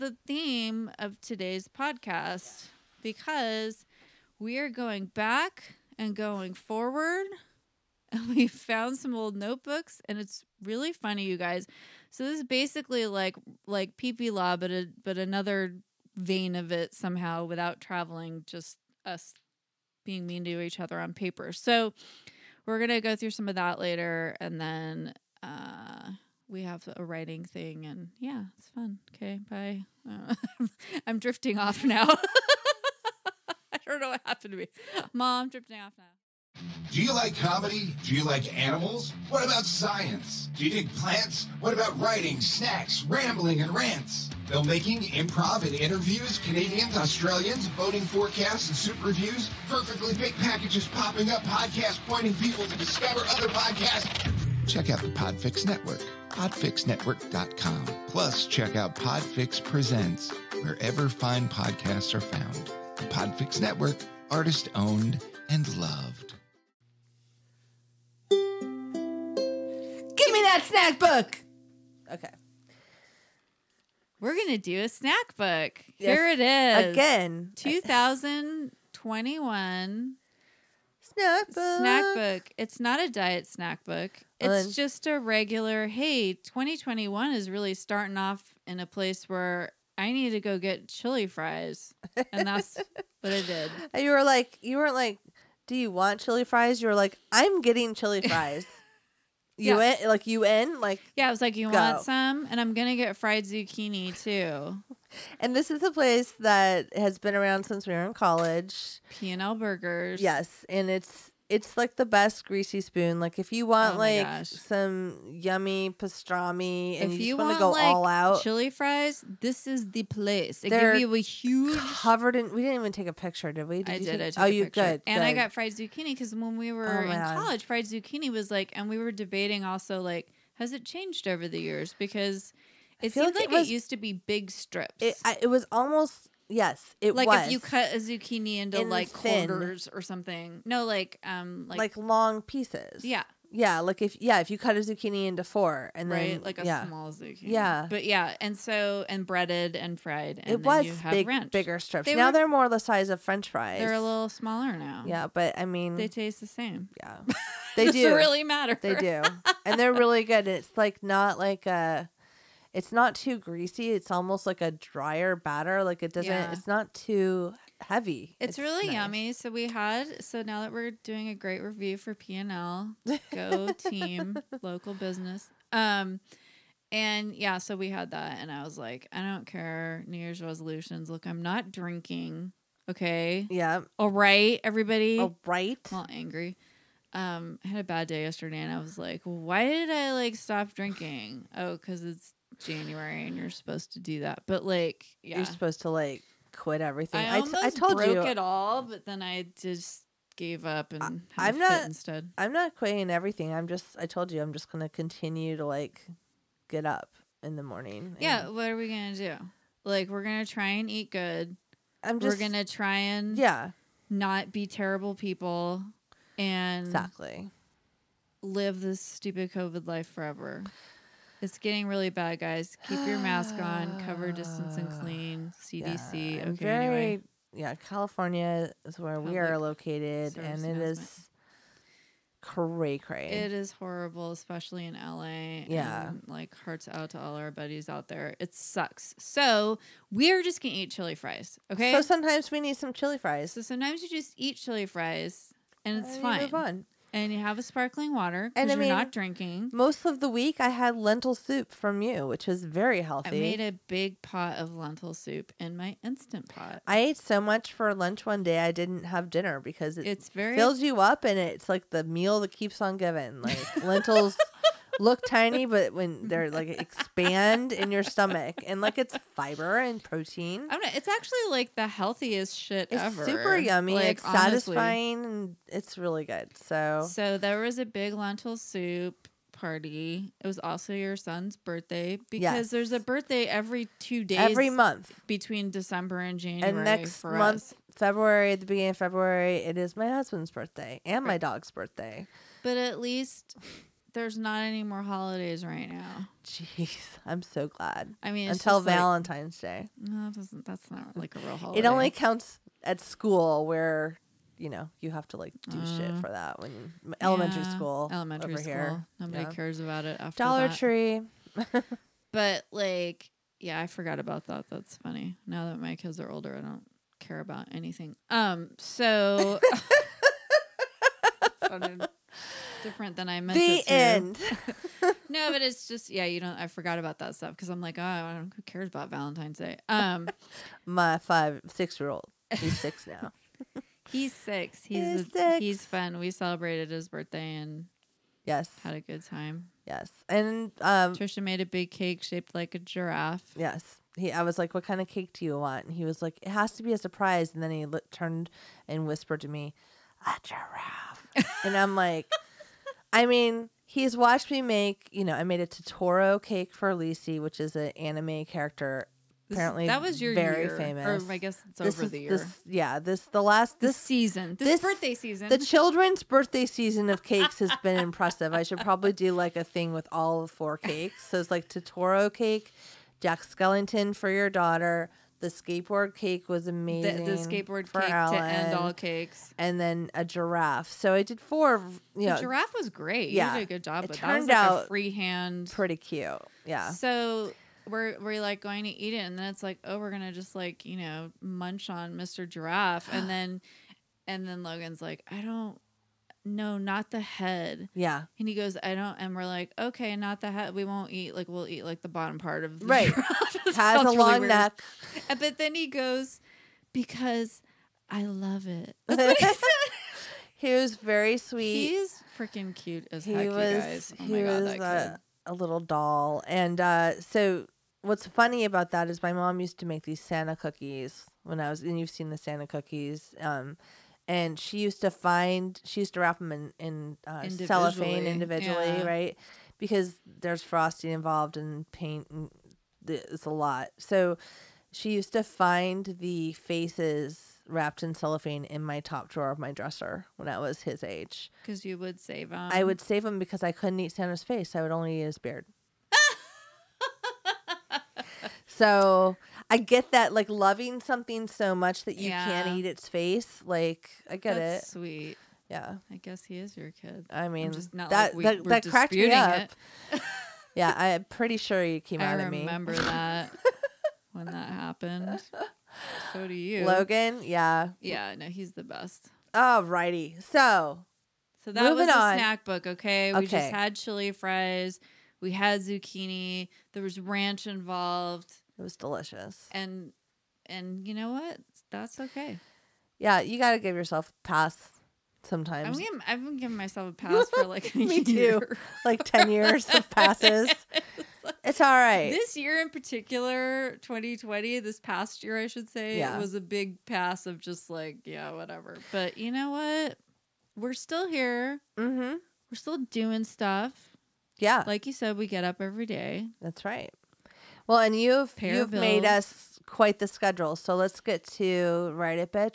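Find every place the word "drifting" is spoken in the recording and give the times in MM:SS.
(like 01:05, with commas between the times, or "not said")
00:31, 00:35.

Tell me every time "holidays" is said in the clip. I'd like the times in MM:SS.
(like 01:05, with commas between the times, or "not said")
04:55, 05:01.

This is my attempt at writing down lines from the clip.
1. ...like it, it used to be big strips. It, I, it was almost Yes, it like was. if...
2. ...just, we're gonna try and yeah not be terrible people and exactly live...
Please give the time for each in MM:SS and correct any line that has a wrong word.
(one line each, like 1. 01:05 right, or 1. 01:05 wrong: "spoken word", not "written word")
1. 02:13 right
2. 03:32 right.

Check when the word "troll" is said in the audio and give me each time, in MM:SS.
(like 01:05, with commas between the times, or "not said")
not said.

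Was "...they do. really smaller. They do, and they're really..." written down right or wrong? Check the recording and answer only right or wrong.
wrong.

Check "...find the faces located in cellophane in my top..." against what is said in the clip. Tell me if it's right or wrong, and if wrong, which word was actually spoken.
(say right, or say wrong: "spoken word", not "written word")
wrong: "wrapped", not "located".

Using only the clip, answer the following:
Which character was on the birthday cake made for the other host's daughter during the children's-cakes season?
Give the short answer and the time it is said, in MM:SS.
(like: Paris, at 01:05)
Jack Skellington, at 06:13.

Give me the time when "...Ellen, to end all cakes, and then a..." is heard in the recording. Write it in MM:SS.
06:18.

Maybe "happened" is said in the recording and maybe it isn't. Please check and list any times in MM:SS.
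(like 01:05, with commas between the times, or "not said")
00:34, 07:44.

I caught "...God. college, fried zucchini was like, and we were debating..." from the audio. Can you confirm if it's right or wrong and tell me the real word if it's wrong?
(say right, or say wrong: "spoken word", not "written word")
right.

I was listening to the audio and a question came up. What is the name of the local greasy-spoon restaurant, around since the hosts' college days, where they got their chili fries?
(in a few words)
P and L Burgers.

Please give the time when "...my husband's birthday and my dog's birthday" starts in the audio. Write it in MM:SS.
04:49.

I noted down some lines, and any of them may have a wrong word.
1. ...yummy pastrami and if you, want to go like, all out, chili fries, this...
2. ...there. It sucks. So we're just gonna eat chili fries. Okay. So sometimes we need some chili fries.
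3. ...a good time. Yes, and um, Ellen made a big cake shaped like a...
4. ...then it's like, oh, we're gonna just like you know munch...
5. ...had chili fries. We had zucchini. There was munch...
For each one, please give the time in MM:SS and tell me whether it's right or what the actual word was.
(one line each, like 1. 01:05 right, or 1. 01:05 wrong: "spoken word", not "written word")
1. 01:55 right
2. 03:58 right
3. 05:38 wrong: "Trisha", not "Ellen"
4. 06:29 right
5. 07:53 wrong: "ranch", not "munch".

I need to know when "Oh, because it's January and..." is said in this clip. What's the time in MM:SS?
03:11.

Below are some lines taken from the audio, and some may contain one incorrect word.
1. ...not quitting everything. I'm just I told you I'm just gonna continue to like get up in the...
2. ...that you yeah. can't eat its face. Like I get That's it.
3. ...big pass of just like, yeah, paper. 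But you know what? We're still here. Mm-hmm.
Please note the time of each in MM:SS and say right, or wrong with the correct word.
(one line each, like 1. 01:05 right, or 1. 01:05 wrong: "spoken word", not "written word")
1. 03:22 right
2. 07:32 right
3. 08:16 wrong: "whatever", not "paper".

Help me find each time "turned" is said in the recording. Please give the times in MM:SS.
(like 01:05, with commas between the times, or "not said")
05:48, 06:24.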